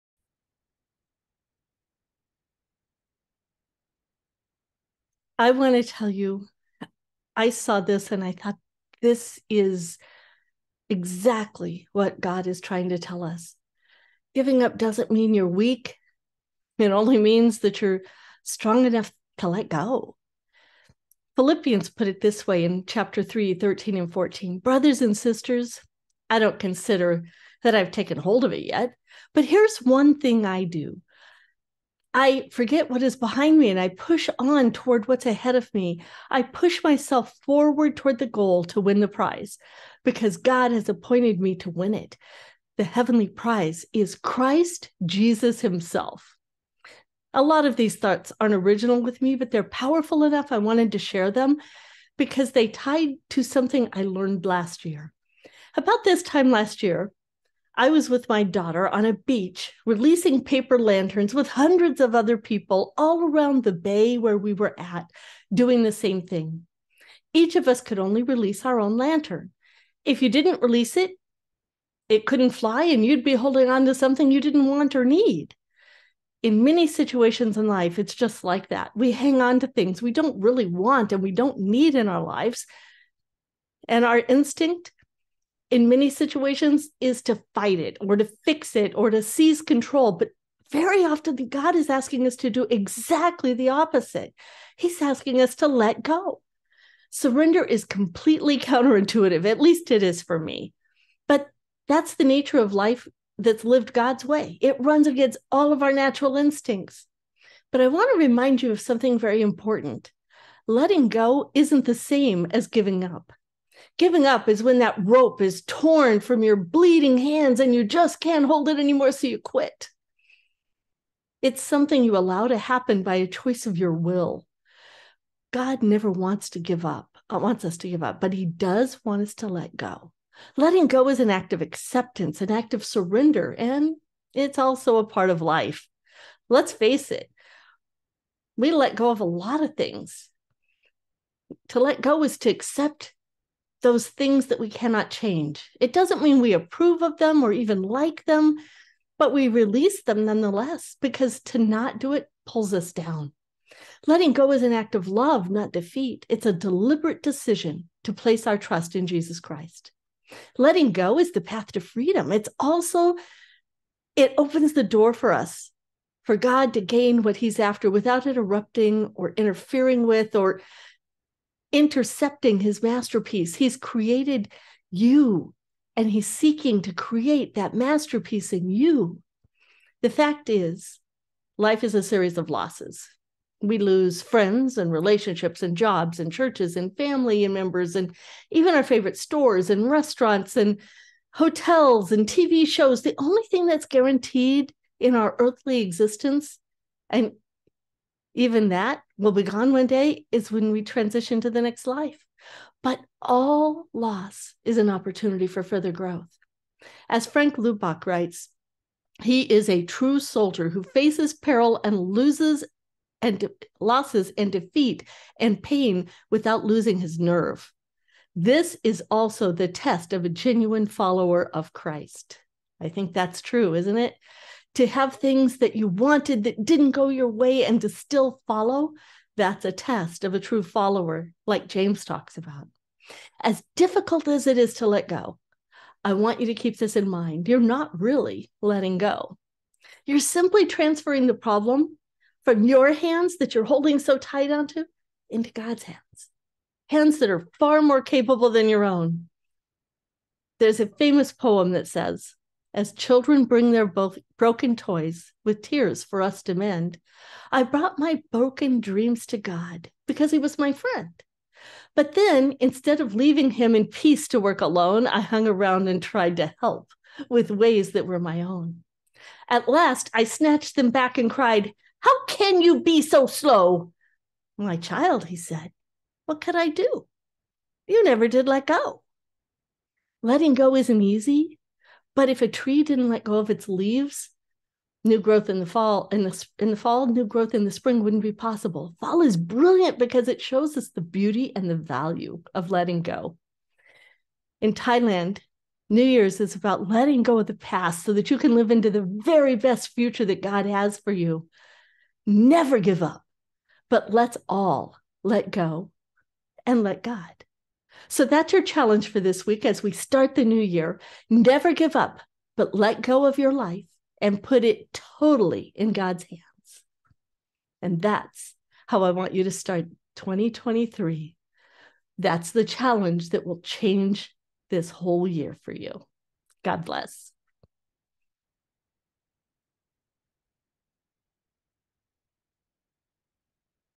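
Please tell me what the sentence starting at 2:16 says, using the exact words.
Let's face it, we let go of a lot of things.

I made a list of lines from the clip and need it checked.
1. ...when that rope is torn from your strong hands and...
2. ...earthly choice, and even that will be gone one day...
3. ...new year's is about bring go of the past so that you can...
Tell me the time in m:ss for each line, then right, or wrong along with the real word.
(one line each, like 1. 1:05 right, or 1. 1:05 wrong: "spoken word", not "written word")
1. 1:54 wrong: "bleeding", not "strong"
2. 3:15 wrong: "existence", not "choice"
3. 4:55 wrong: "letting", not "bring".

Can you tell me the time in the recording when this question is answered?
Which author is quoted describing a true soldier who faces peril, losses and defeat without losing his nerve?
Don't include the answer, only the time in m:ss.
3:27.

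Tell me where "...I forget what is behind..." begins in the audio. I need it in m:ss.
0:32.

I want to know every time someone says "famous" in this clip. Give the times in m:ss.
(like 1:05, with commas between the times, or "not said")
4:10.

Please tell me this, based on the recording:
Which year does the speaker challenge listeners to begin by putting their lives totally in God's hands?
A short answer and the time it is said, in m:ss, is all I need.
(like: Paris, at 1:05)
2023, at 5:20.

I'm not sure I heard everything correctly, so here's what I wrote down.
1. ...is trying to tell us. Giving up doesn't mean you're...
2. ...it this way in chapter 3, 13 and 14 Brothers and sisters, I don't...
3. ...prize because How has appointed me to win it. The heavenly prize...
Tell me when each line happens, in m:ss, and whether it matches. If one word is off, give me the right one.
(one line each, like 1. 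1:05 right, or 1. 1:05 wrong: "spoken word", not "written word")
1. 0:12 right
2. 0:22 right
3. 0:39 wrong: "God", not "How".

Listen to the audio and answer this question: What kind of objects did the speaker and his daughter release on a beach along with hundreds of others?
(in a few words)
Paper lanterns.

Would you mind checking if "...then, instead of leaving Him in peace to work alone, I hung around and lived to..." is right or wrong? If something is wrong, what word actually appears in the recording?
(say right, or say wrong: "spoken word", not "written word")
wrong: "tried", not "lived".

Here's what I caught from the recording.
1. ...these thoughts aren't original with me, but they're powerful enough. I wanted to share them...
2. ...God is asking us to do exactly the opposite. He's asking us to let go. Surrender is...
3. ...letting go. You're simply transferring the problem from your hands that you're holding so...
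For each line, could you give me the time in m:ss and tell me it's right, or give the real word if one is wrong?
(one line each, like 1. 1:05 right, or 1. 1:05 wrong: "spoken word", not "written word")
1. 0:47 right
2. 1:31 right
3. 3:58 right.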